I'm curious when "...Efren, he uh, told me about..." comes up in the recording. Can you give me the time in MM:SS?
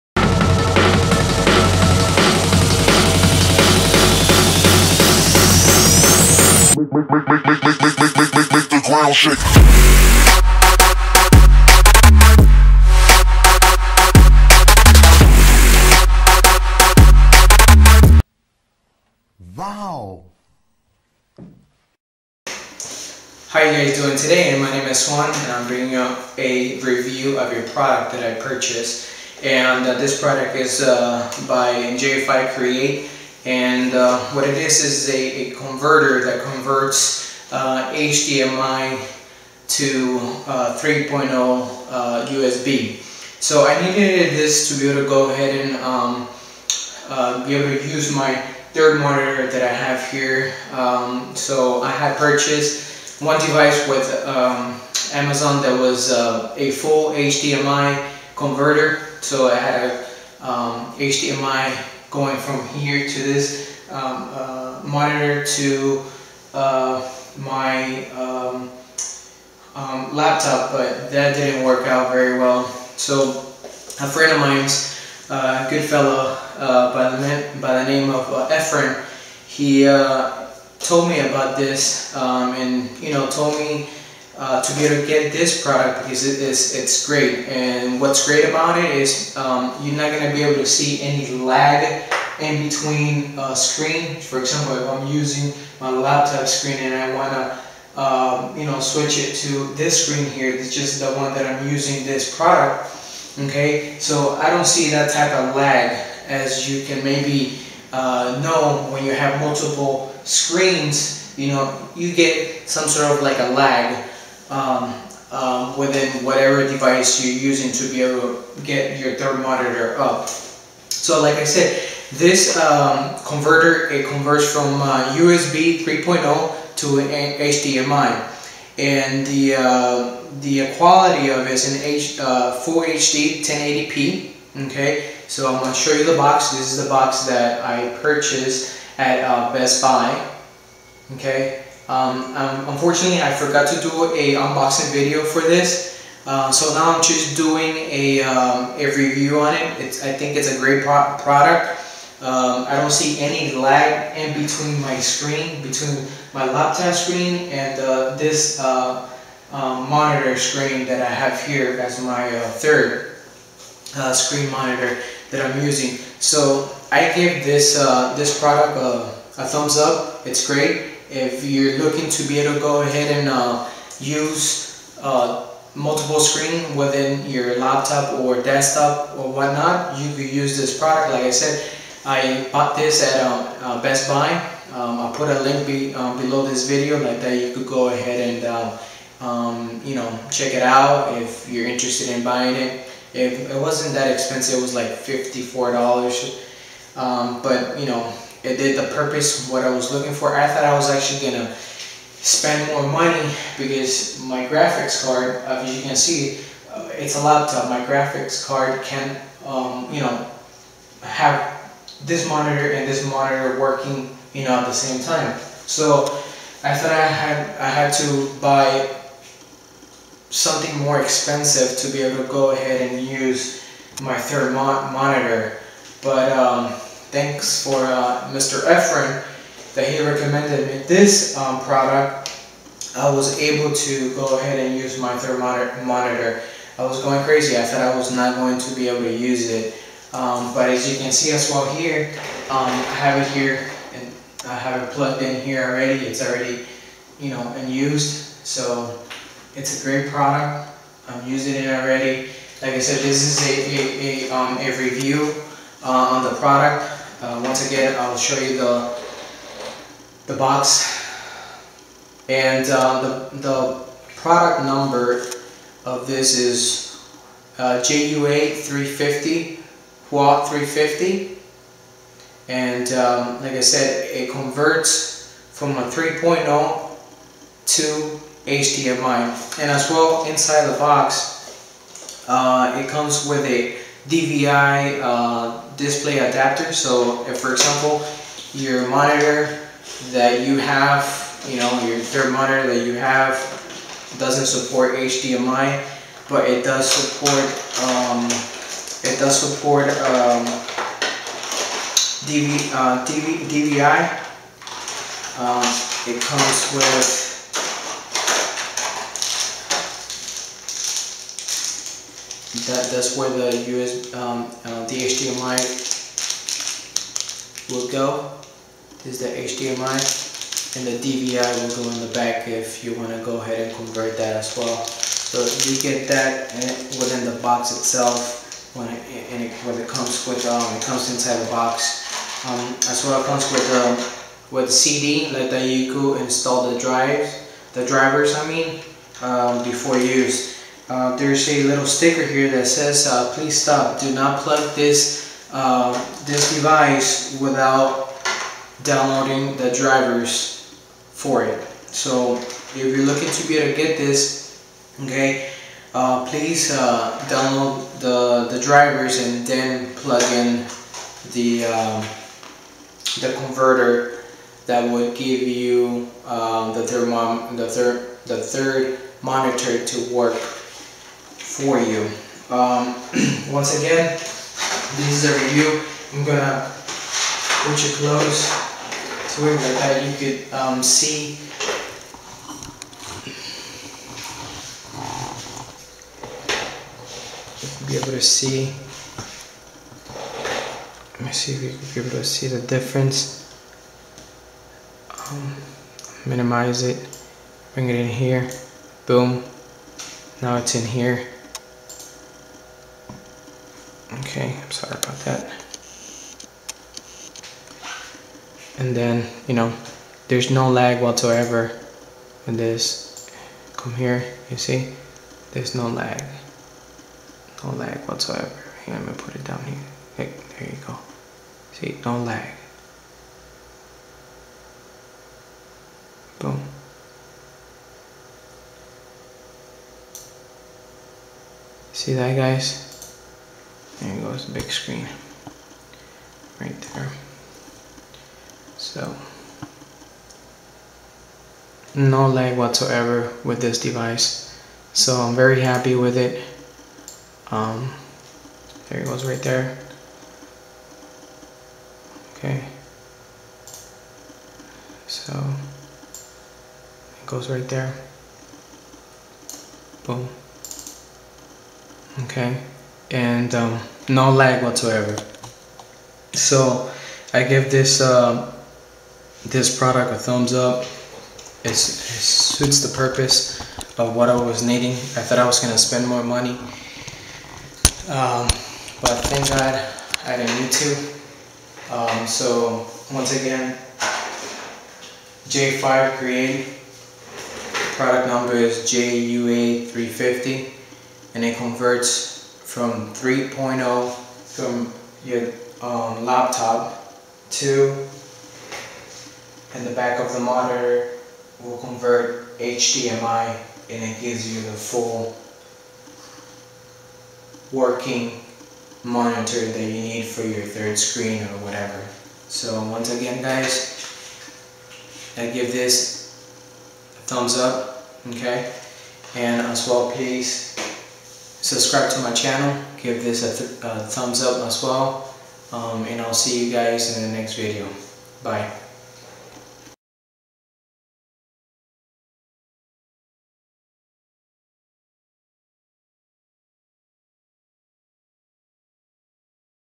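01:18.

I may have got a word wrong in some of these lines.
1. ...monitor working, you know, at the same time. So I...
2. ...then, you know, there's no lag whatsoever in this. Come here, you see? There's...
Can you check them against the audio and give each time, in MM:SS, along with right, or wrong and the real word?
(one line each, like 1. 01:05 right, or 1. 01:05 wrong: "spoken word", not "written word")
1. 03:33 right
2. 06:48 right.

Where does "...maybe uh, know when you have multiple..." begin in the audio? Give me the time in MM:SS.
01:47.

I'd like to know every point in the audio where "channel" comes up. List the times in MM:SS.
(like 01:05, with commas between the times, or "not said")
08:42.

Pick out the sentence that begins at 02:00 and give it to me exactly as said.
So like I said, this um, converter, it converts from uh, USB 3.0 to an HDMI.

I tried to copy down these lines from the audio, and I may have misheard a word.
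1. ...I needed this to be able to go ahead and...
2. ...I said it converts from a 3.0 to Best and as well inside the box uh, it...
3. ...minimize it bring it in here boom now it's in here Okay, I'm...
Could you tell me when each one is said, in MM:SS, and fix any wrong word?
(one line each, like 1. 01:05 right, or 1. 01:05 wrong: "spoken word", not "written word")
1. 00:43 right
2. 04:33 wrong: "HDMI", not "Best"
3. 06:36 right.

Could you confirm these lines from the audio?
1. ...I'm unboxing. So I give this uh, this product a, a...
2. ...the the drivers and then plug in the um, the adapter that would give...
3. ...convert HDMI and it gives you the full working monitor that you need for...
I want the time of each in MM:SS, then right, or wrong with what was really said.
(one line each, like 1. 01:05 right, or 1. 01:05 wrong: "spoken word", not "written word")
1. 02:45 wrong: "using", not "unboxing"
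2. 05:58 wrong: "converter", not "adapter"
3. 08:21 right.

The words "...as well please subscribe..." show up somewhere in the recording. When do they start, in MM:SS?
08:39.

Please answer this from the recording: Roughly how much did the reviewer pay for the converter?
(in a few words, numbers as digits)
$54.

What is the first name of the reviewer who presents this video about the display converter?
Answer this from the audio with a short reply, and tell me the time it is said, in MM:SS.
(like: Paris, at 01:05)
Juan, at 00:25.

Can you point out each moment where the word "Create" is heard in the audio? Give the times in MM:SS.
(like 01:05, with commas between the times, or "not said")
00:32, 08:06.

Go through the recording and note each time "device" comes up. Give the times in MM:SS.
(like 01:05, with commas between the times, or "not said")
00:53, 01:56, 05:46, 07:23.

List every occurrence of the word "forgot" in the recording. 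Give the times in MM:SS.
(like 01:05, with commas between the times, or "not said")
02:23.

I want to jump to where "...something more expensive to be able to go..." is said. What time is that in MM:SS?
03:40.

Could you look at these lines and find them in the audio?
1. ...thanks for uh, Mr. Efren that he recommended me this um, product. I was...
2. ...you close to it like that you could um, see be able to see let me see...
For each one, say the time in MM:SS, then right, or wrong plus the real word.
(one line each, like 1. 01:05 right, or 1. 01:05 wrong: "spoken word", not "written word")
1. 03:47 right
2. 06:17 right.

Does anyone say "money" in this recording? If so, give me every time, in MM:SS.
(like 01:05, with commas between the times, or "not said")
03:22, 07:56.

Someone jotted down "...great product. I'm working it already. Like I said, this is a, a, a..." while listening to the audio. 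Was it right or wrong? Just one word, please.
wrong.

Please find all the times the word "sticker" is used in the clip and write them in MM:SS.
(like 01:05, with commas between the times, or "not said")
05:41.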